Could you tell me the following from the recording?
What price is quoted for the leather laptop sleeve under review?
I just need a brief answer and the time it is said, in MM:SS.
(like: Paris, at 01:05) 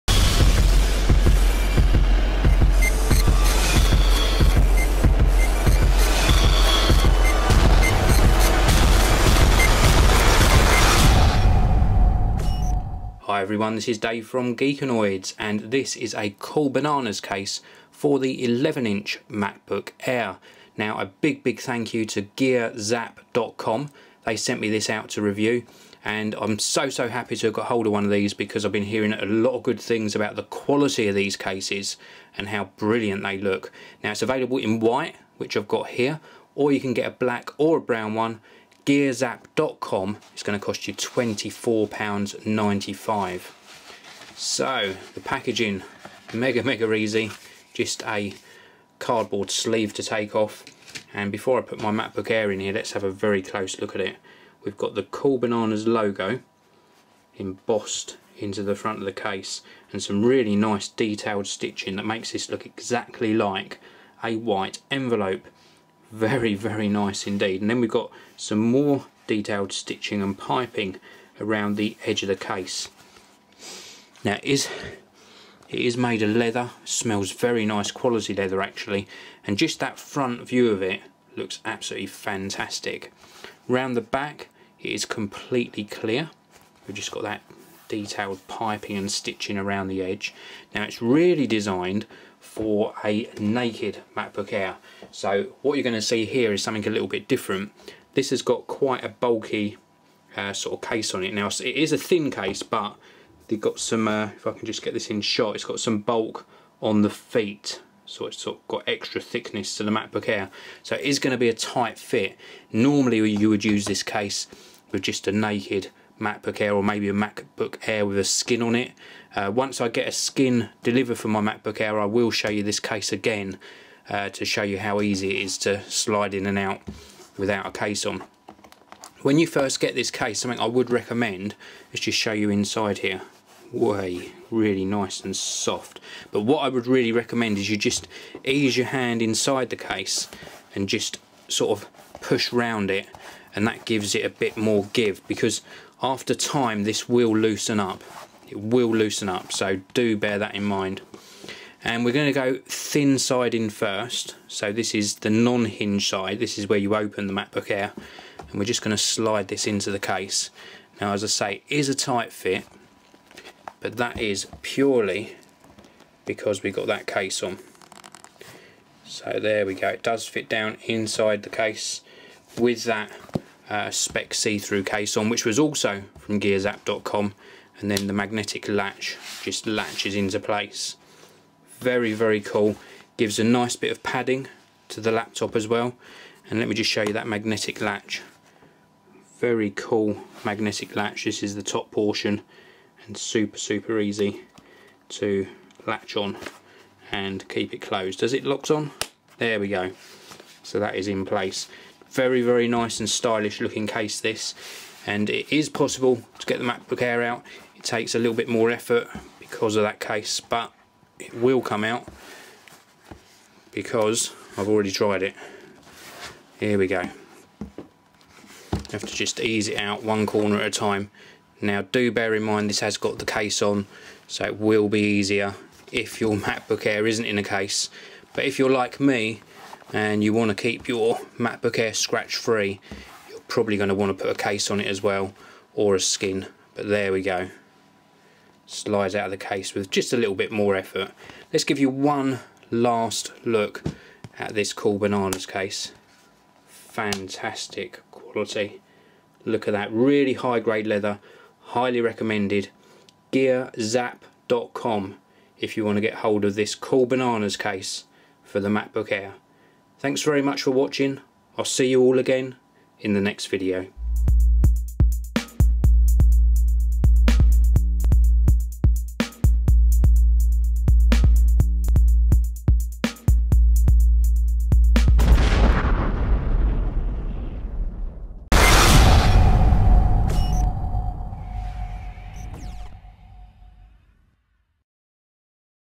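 £24.95, at 00:40.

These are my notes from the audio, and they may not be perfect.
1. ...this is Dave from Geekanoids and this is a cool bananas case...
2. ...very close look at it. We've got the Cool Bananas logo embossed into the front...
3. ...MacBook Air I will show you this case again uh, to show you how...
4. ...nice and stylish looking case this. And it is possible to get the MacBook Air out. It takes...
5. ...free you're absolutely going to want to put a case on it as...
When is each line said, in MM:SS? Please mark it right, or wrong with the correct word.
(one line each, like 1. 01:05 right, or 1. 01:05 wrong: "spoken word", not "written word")
1. 00:13 right
2. 00:53 right
3. 02:01 right
4. 03:22 right
5. 03:52 wrong: "probably", not "absolutely".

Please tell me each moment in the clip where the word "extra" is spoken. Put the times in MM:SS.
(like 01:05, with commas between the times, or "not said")
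01:48.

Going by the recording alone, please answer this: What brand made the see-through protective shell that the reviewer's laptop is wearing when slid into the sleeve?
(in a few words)
Speck.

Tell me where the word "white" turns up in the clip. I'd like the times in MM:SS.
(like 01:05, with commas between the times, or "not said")
00:34, 01:04.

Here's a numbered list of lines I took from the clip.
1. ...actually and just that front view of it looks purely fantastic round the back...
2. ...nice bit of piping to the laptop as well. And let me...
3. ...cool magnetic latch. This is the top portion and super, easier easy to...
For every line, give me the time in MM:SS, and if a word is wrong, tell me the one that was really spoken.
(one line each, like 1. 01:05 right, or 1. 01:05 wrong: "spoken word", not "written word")
1. 01:18 wrong: "absolutely", not "purely"
2. 03:03 wrong: "padding", not "piping"
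3. 03:09 wrong: "super", not "easier".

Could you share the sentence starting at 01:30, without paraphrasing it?
Now it's really designed for a naked MacBook Air.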